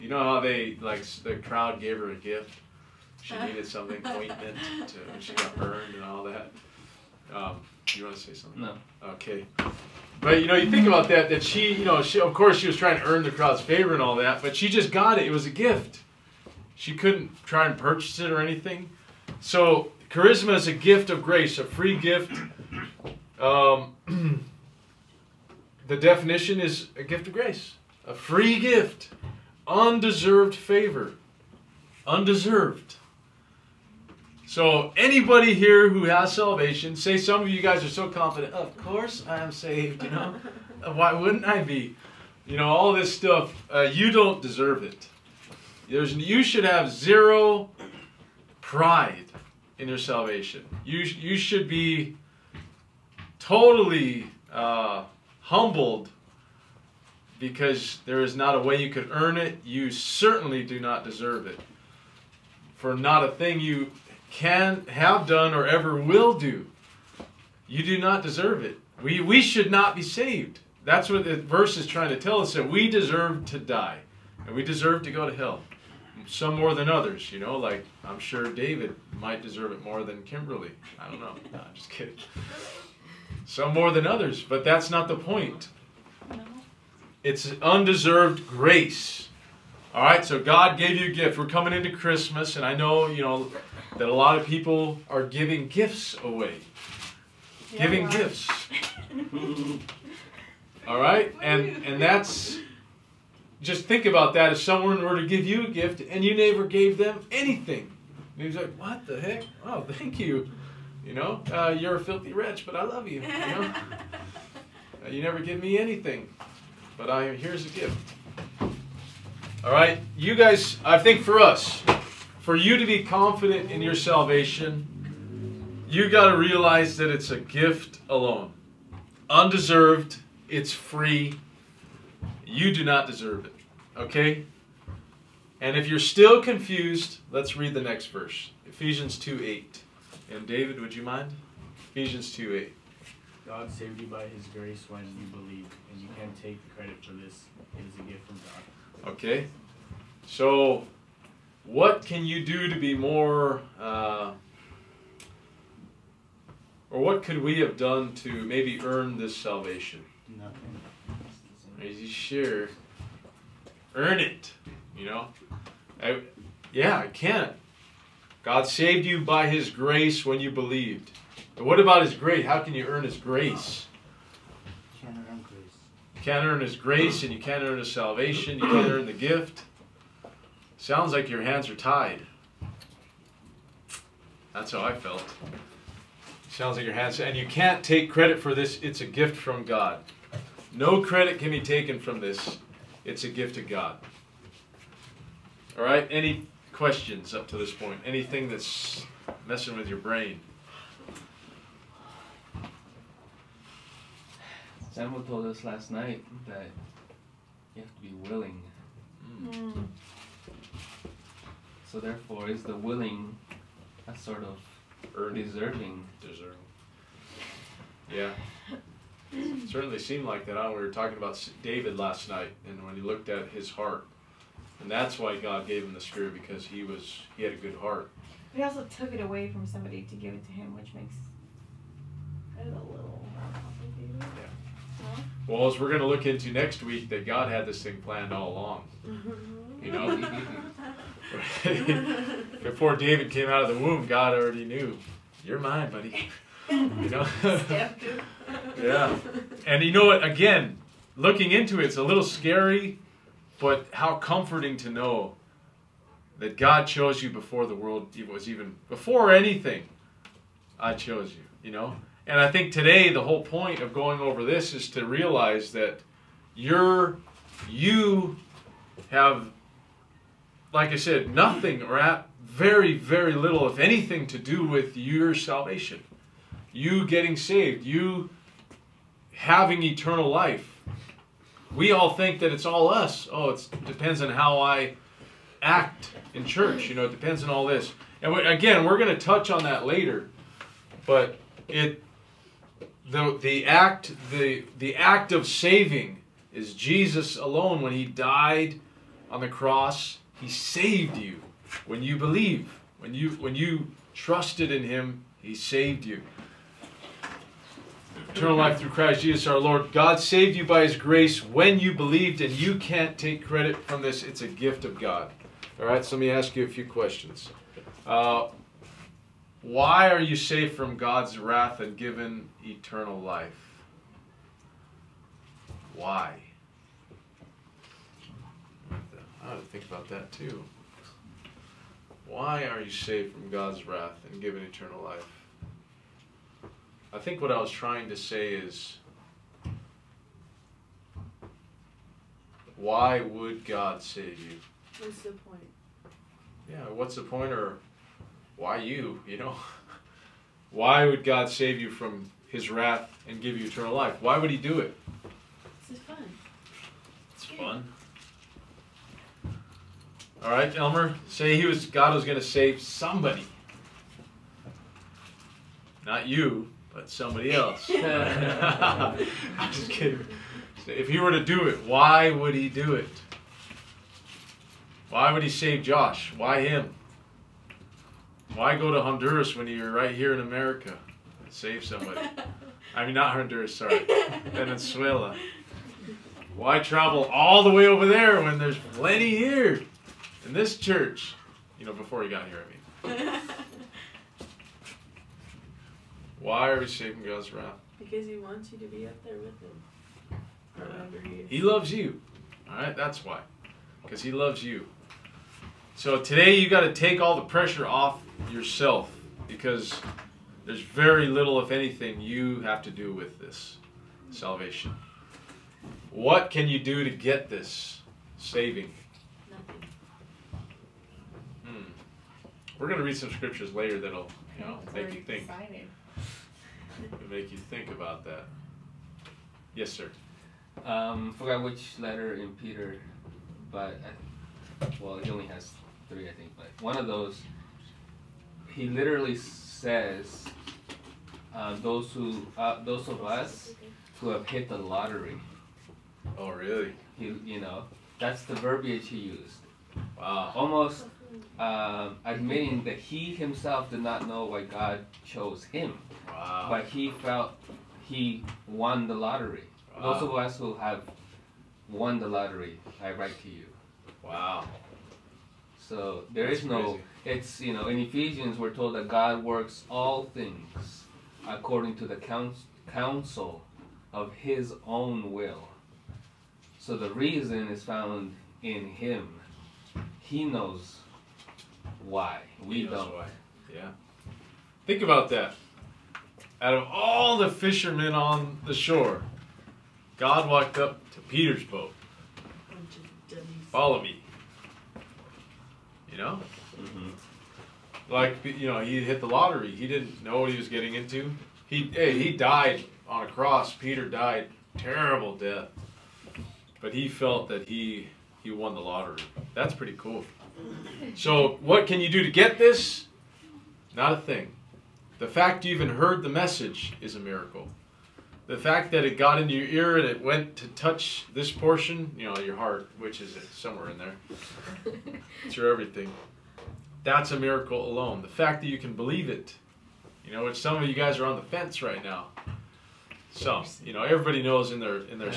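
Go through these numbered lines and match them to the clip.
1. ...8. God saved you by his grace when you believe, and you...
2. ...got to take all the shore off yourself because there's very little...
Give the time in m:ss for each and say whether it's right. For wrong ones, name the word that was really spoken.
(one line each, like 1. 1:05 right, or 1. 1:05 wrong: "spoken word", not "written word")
1. 2:22 right
2. 6:46 wrong: "pressure", not "shore".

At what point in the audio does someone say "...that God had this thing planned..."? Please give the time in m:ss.
3:57.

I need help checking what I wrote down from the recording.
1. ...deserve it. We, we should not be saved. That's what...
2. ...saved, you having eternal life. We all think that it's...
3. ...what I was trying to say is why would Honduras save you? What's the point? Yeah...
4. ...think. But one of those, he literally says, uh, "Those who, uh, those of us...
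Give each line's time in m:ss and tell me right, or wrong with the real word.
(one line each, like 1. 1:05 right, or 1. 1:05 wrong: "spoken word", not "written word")
1. 1:08 right
2. 4:37 right
3. 5:37 wrong: "God", not "Honduras"
4. 7:16 right.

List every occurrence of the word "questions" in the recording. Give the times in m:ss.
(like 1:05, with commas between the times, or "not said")
3:16, 5:16.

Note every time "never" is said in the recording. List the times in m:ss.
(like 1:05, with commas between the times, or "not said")
1:46, 1:55.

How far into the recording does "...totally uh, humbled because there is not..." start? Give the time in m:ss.
0:53.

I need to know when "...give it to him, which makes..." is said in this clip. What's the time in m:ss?
3:50.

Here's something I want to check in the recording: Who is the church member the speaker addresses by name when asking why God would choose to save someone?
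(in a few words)
Elmer.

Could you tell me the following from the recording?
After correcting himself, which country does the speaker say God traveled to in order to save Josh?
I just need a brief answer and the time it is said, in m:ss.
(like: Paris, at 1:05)
Venezuela, at 6:24.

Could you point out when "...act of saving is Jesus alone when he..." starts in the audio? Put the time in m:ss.
4:54.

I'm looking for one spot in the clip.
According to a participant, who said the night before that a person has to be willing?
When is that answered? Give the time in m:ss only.
3:24.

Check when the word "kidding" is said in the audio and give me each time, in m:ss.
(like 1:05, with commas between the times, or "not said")
1:21, 6:09.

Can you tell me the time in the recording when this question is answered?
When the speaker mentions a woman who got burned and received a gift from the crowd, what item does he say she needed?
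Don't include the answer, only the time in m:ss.
0:04.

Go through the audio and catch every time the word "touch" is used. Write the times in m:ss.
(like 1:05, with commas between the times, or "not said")
4:49, 8:40.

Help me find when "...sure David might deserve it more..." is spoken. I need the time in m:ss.
1:18.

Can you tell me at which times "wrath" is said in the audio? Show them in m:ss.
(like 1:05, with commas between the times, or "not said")
5:21, 5:33, 5:52, 6:37.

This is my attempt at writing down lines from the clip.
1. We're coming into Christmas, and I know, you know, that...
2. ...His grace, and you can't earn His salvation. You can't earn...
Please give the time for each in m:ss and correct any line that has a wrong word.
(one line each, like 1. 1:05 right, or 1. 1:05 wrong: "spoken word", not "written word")
1. 1:31 right
2. 2:56 right.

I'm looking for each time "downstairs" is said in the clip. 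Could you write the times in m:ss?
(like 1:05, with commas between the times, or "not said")
not said.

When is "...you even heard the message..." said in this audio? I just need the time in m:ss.
8:35.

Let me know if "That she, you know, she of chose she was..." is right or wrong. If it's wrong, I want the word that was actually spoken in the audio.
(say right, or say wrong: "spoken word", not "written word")
wrong: "course", not "chose".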